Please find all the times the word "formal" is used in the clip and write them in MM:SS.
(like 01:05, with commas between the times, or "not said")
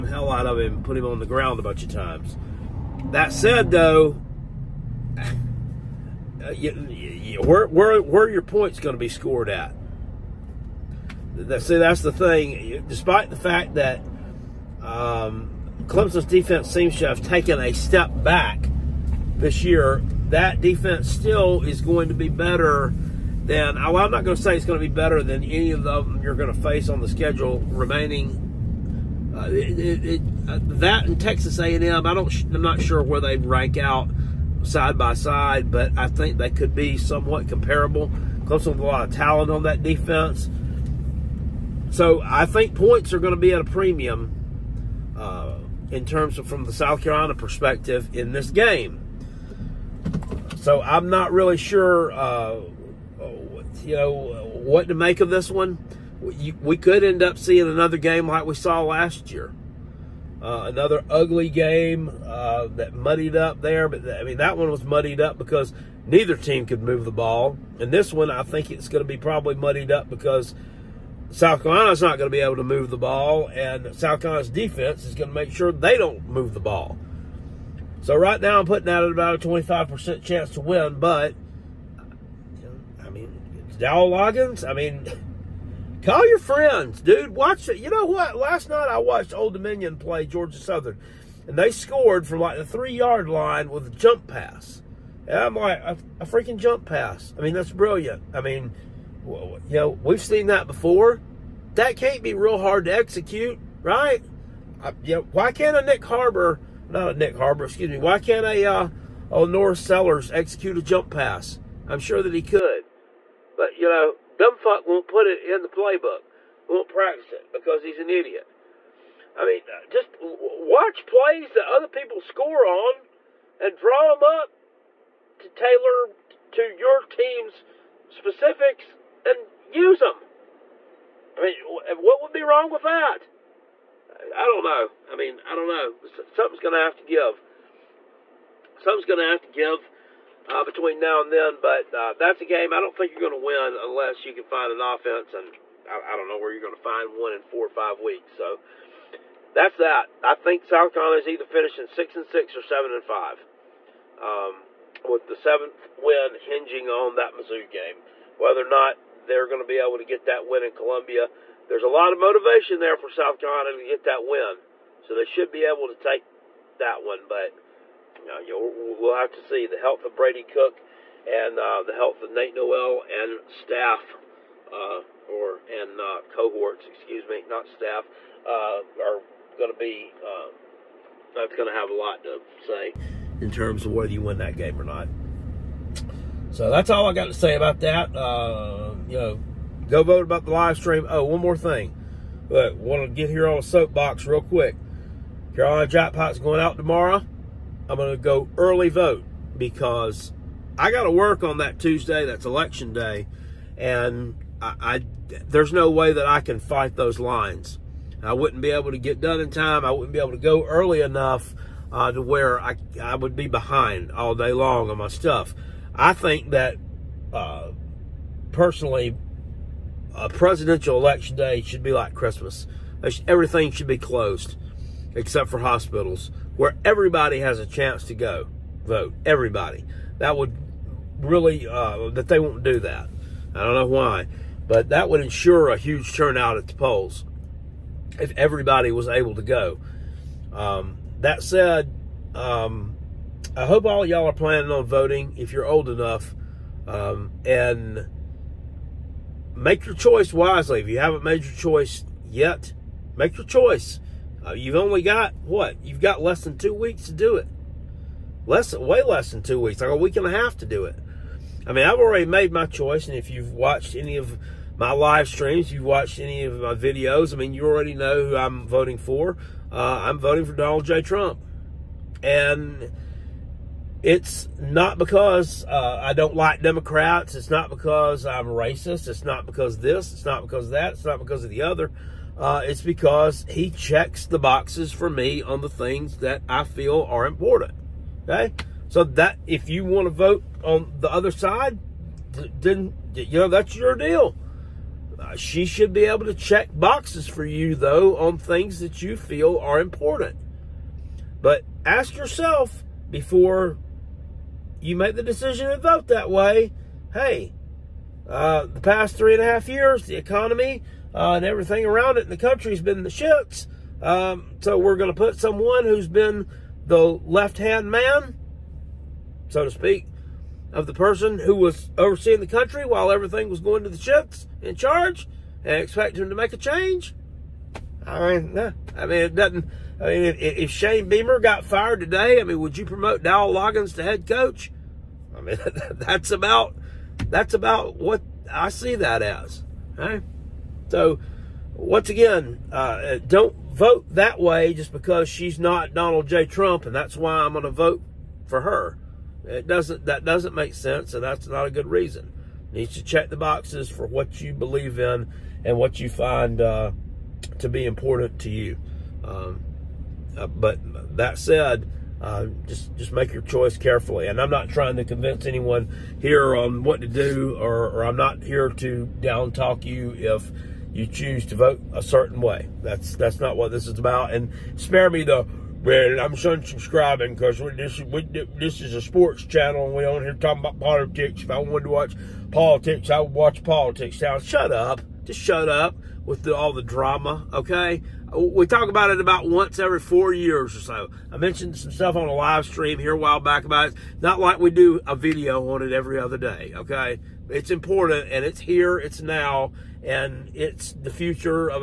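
not said.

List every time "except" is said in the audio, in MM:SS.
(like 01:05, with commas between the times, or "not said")
03:45.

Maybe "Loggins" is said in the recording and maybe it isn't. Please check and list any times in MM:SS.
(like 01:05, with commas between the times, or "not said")
01:24, 05:33.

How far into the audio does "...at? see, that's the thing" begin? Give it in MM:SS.
00:09.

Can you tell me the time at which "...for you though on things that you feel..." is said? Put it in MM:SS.
04:57.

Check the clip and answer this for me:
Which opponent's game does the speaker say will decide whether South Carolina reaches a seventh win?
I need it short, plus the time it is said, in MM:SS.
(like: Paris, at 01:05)
Mizzou, at 02:37.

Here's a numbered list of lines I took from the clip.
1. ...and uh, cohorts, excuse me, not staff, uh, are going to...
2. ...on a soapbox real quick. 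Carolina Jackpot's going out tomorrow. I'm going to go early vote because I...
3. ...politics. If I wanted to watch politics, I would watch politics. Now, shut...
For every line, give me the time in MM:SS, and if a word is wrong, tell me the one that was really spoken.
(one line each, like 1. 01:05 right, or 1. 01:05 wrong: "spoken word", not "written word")
1. 02:55 right
2. 03:13 right
3. 06:20 right.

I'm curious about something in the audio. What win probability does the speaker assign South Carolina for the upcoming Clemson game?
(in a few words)
25%.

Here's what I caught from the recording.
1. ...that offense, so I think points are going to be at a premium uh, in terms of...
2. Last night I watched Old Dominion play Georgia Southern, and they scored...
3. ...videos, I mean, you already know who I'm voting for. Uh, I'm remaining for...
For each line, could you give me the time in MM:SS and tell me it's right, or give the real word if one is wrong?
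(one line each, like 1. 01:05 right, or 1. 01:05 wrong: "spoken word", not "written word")
1. 00:39 wrong: "defense", not "offense"
2. 01:28 right
3. 04:26 wrong: "voting", not "remaining".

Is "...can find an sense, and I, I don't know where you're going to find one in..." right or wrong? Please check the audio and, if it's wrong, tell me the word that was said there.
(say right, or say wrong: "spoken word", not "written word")
wrong: "offense", not "sense".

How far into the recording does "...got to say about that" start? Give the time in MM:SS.
03:07.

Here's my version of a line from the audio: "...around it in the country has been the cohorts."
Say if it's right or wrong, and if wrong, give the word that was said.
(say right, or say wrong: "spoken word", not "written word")
wrong: "shits", not "cohorts".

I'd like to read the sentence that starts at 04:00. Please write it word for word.
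Um, that said, um, I hope all y'all are planning on voting if you're old enough um, and make your choice wisely.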